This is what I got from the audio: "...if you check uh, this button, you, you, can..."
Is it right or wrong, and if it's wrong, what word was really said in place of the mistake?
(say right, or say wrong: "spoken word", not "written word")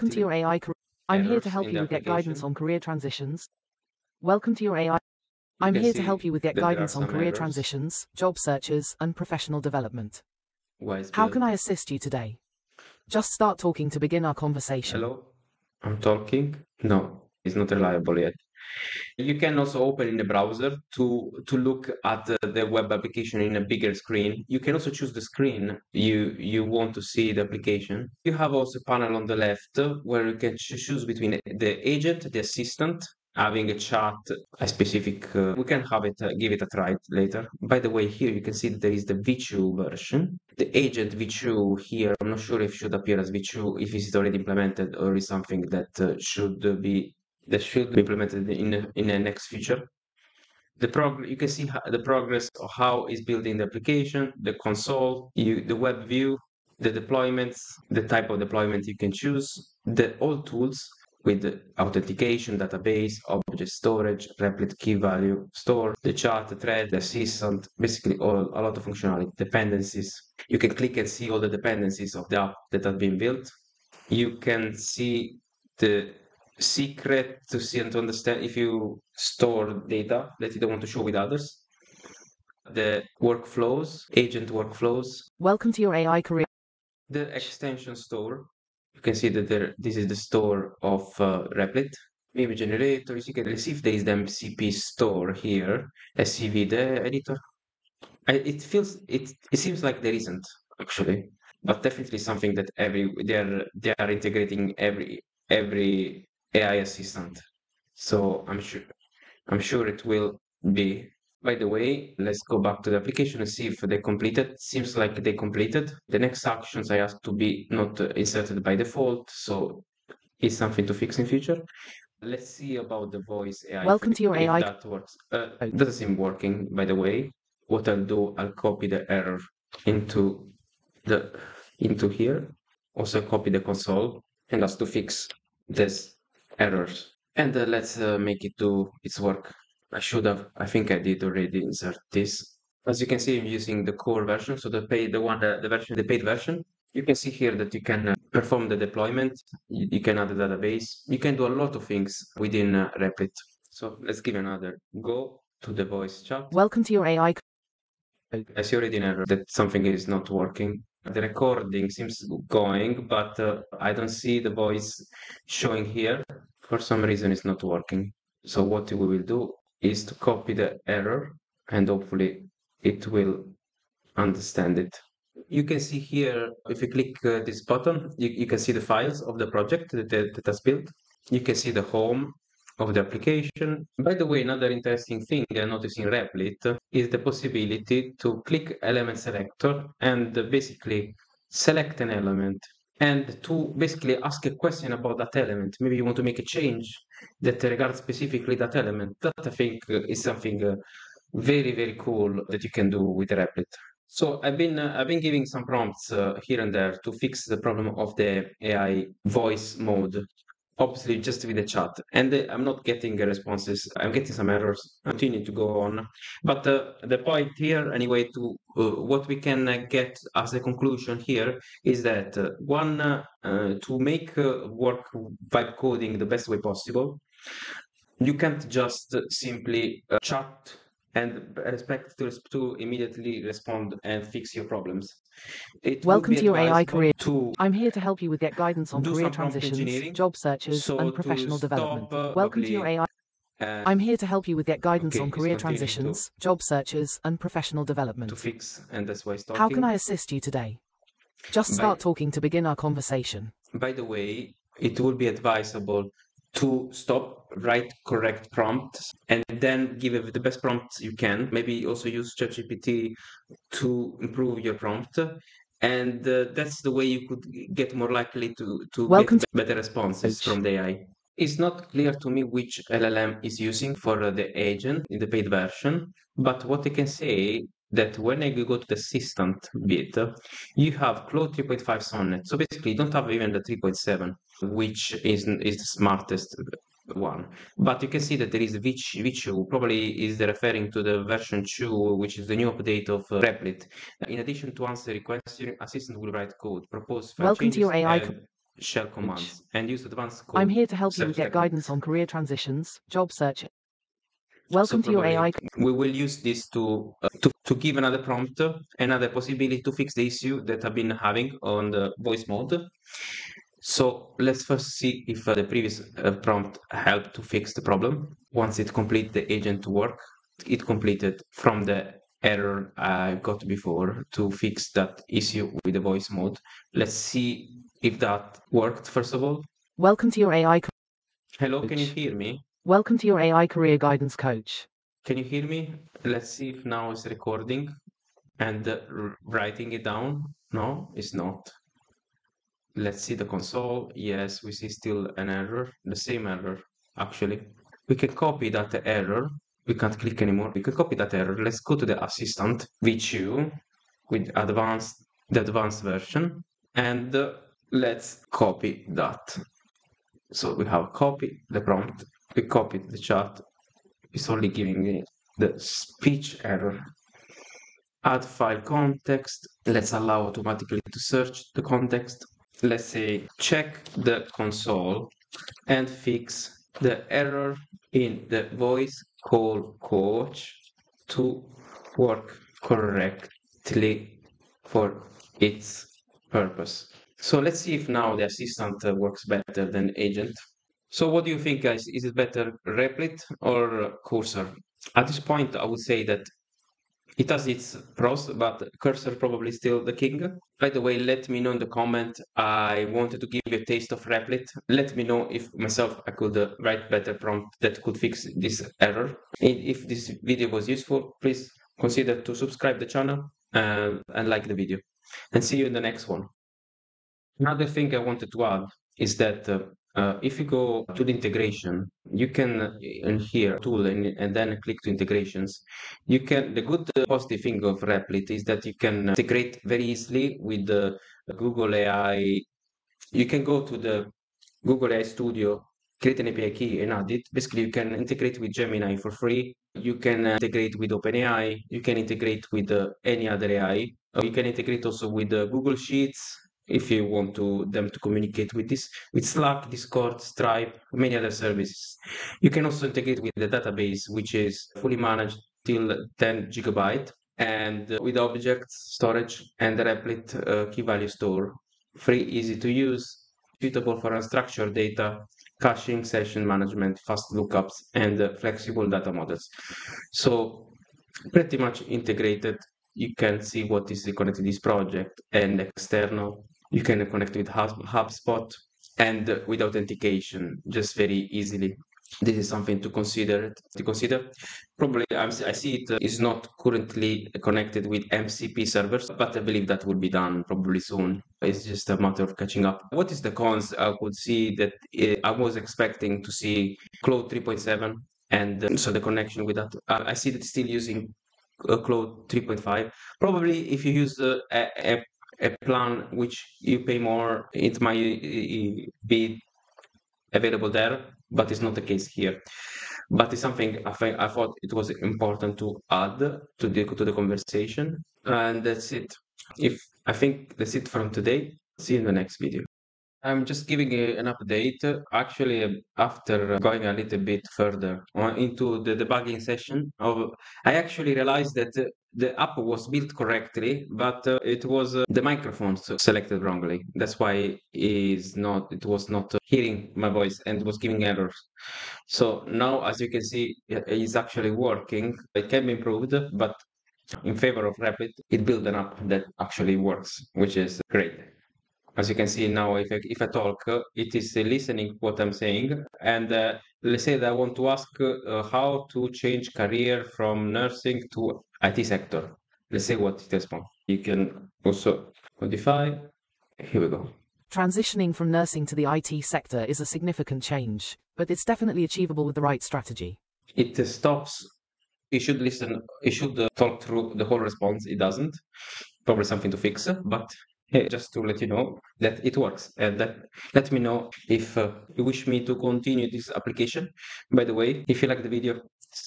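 wrong: "click", not "check".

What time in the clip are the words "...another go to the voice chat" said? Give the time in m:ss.
2:34.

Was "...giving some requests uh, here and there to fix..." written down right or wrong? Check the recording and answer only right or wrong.
wrong.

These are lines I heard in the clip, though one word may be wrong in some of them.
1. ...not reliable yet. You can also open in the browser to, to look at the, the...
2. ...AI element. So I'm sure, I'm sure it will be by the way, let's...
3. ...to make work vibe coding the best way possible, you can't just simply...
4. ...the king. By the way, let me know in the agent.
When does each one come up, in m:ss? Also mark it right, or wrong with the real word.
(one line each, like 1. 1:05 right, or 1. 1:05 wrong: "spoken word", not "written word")
1. 0:17 right
2. 1:46 wrong: "assistant", not "element"
3. 3:43 right
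4. 6:40 wrong: "comment", not "agent".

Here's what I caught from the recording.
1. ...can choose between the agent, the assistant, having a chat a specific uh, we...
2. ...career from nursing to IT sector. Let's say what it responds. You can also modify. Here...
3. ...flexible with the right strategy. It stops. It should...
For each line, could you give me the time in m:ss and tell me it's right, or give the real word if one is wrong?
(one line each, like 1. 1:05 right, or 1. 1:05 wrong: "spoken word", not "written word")
1. 0:30 right
2. 9:19 right
3. 9:32 wrong: "achievable", not "flexible".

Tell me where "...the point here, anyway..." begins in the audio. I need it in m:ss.
3:37.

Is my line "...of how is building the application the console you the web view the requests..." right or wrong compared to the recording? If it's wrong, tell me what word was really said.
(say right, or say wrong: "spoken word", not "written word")
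wrong: "deployments", not "requests".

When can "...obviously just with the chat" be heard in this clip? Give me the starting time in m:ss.
3:30.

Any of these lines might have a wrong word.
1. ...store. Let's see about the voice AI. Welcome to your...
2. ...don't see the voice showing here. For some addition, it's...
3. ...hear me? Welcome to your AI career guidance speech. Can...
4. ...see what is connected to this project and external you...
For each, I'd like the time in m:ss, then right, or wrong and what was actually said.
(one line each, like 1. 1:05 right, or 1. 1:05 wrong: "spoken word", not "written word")
1. 2:01 wrong: "future", not "store"
2. 2:43 wrong: "reason", not "addition"
3. 5:32 wrong: "coach", not "speech"
4. 7:53 right.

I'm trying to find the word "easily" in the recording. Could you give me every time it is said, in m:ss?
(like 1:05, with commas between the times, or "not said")
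7:10, 8:01.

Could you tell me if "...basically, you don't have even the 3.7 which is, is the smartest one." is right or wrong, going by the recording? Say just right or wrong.
right.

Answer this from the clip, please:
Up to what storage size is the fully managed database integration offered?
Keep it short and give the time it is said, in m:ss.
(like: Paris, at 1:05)
10 gigabytes, at 7:36.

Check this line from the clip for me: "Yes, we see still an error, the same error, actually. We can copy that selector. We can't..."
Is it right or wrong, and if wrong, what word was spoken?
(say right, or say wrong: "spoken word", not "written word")
wrong: "error", not "selector".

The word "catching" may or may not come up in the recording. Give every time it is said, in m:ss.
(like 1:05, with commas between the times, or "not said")
8:12.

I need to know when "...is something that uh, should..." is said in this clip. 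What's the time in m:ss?
0:45.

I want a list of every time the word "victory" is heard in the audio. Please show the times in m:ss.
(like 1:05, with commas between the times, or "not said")
not said.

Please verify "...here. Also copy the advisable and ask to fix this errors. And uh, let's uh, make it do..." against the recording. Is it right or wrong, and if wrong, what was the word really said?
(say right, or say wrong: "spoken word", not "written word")
wrong: "console", not "advisable".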